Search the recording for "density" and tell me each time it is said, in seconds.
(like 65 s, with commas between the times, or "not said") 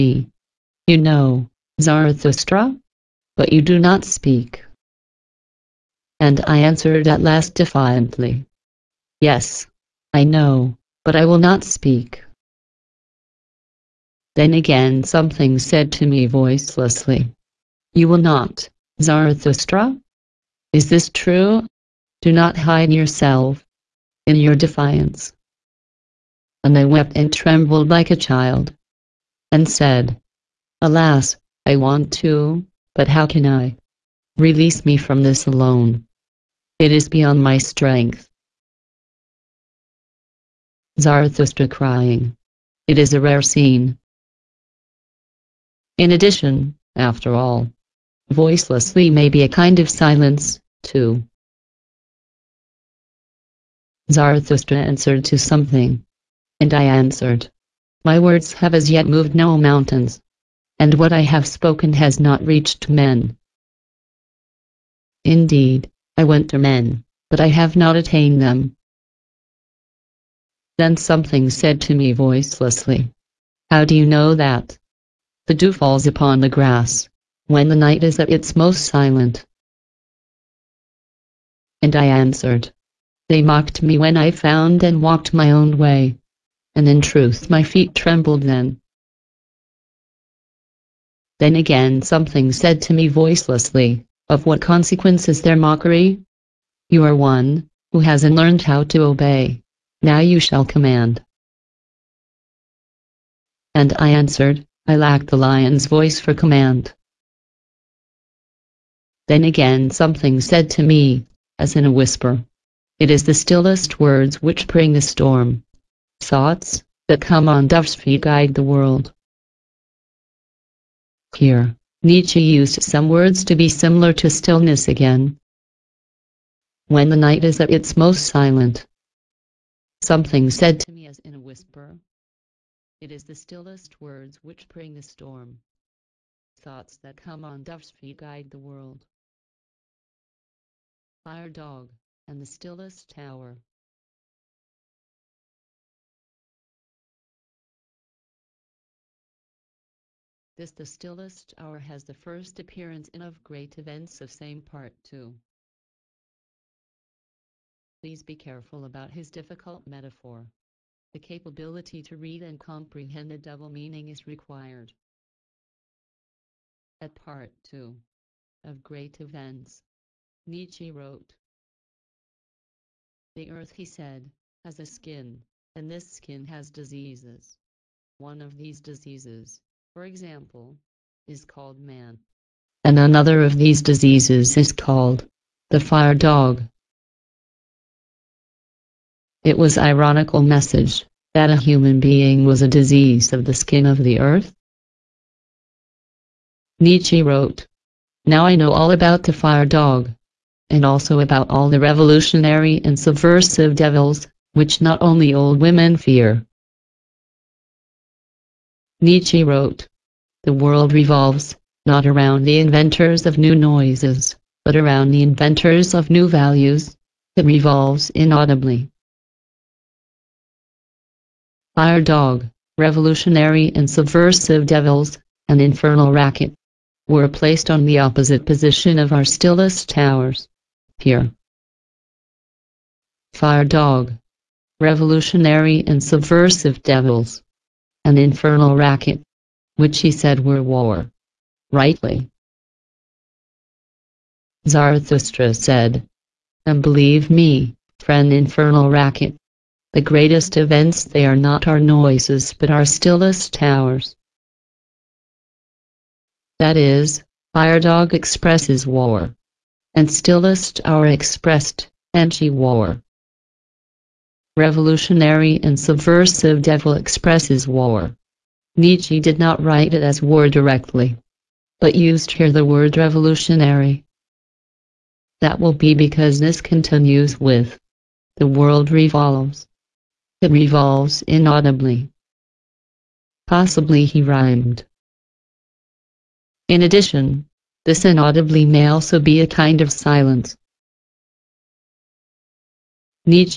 not said.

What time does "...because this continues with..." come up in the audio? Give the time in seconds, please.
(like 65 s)
275 s.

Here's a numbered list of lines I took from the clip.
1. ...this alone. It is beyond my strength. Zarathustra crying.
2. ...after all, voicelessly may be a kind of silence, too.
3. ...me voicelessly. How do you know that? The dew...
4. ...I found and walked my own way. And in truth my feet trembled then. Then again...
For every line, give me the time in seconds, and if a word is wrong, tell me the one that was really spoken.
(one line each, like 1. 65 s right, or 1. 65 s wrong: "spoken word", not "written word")
1. 35 s right
2. 46 s right
3. 71 s right
4. 84 s right.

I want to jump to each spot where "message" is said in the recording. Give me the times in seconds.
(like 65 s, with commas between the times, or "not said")
190 s.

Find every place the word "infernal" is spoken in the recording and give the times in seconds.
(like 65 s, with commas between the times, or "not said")
225 s, 238 s, 248 s.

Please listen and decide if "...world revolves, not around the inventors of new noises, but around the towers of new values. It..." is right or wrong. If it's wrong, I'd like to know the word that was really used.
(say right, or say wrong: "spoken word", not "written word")
wrong: "inventors", not "towers".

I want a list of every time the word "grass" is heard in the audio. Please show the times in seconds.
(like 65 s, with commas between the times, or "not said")
76 s.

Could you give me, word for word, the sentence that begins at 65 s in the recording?
Indeed, I went to men, but I have not attained them.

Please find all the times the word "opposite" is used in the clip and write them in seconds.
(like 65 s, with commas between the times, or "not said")
227 s.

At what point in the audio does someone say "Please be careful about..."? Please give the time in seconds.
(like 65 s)
158 s.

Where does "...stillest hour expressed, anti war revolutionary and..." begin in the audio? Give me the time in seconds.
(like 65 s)
260 s.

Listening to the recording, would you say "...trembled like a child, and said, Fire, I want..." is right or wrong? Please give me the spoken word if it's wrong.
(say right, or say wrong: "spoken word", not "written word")
wrong: "Alas", not "Fire".